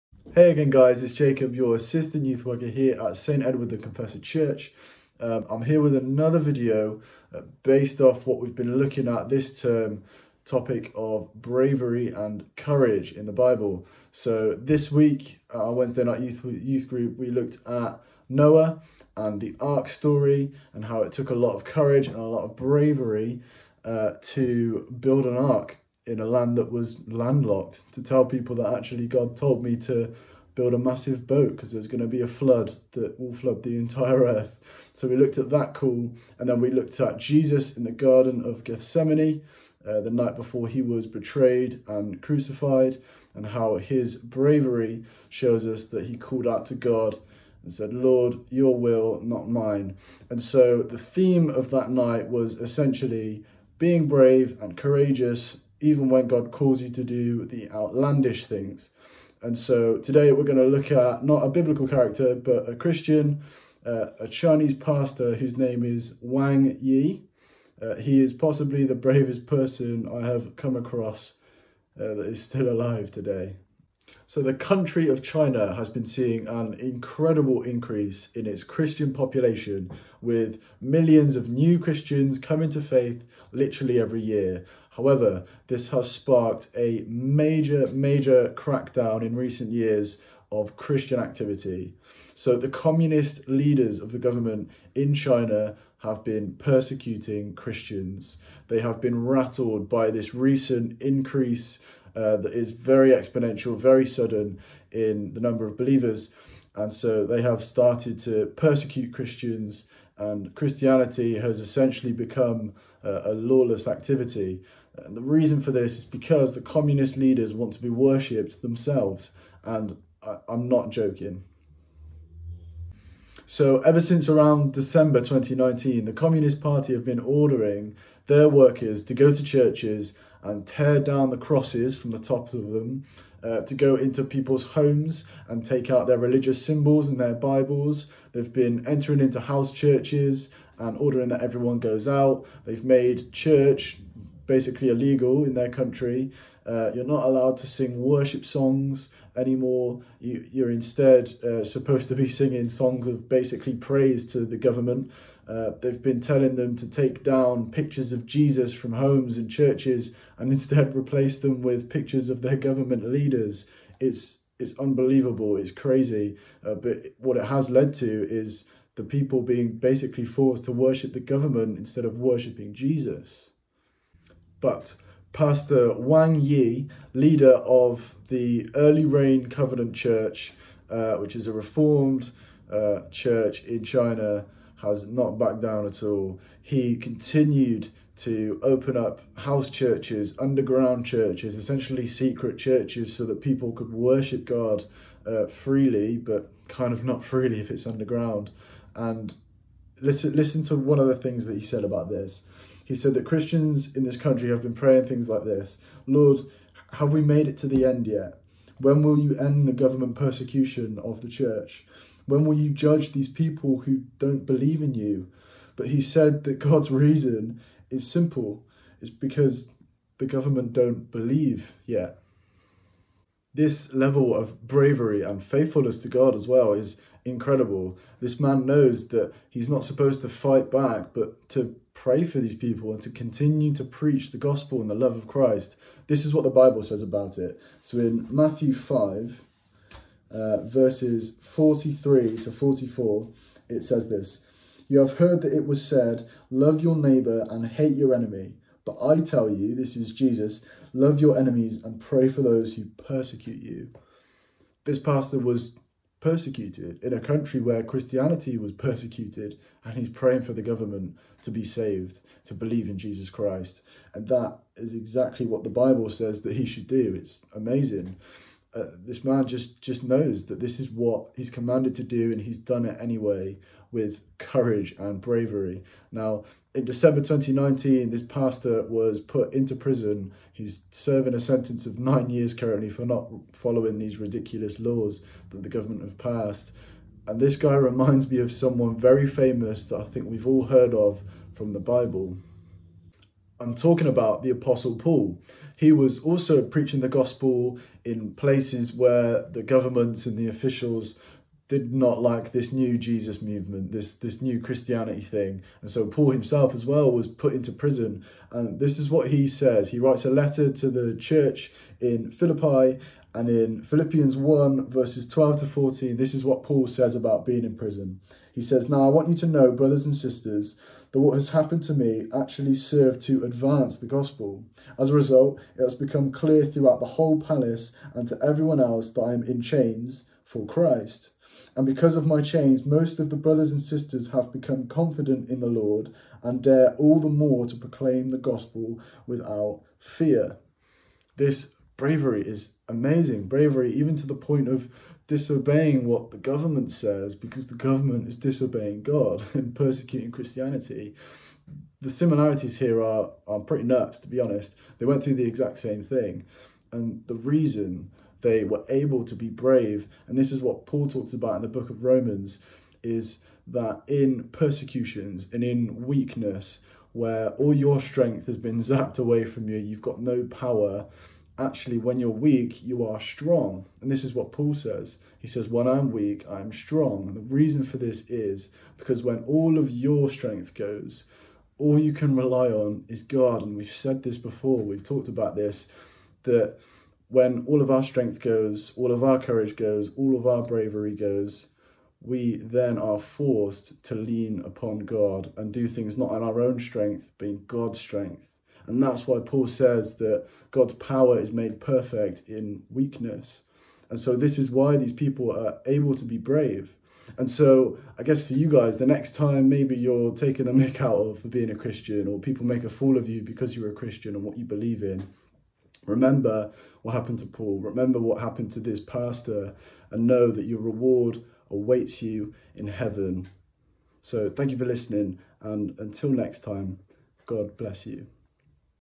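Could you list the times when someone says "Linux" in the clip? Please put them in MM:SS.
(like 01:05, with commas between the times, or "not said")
not said.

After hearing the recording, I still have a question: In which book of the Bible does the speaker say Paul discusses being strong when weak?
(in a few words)
Romans.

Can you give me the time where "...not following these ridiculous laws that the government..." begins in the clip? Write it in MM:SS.
04:43.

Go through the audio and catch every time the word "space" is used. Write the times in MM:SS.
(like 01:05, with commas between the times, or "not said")
not said.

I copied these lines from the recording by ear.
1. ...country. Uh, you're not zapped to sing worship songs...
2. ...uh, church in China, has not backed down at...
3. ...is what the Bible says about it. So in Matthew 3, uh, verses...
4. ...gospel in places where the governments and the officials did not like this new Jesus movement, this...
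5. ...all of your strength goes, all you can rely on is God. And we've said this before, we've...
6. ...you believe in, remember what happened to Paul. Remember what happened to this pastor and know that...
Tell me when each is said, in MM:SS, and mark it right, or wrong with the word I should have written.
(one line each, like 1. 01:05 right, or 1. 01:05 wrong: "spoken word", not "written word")
1. 02:25 wrong: "allowed", not "zapped"
2. 03:02 right
3. 03:56 wrong: "5", not "3"
4. 04:57 right
5. 06:19 right
6. 06:54 right.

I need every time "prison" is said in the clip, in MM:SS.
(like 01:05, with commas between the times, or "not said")
04:39, 05:07, 05:17.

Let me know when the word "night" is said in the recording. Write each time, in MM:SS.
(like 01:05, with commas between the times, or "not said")
00:16, 00:40, 00:51.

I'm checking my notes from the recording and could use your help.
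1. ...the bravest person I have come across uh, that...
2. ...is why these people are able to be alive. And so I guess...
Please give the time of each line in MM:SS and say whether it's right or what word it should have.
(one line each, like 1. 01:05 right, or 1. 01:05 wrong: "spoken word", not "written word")
1. 01:08 right
2. 06:44 wrong: "brave", not "alive".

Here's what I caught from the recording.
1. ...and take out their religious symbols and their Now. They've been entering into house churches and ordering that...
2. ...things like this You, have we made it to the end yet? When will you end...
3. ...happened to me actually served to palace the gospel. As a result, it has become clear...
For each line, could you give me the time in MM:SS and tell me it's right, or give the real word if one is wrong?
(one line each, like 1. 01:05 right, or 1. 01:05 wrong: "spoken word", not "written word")
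1. 02:15 wrong: "Bibles", not "Now"
2. 03:25 wrong: "Lord", not "You"
3. 05:21 wrong: "advance", not "palace".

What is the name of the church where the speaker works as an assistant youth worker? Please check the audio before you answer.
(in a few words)
St. Edward the Confessor Church.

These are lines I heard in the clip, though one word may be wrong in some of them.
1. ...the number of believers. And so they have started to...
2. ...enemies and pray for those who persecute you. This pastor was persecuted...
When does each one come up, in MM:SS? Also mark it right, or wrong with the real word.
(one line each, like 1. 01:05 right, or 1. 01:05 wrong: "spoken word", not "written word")
1. 01:45 right
2. 04:11 right.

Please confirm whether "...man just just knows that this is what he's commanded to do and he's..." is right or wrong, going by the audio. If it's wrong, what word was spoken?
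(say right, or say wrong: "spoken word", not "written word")
right.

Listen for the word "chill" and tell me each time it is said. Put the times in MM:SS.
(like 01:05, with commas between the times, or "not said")
not said.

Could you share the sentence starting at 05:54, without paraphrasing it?
They went through the exact same thing.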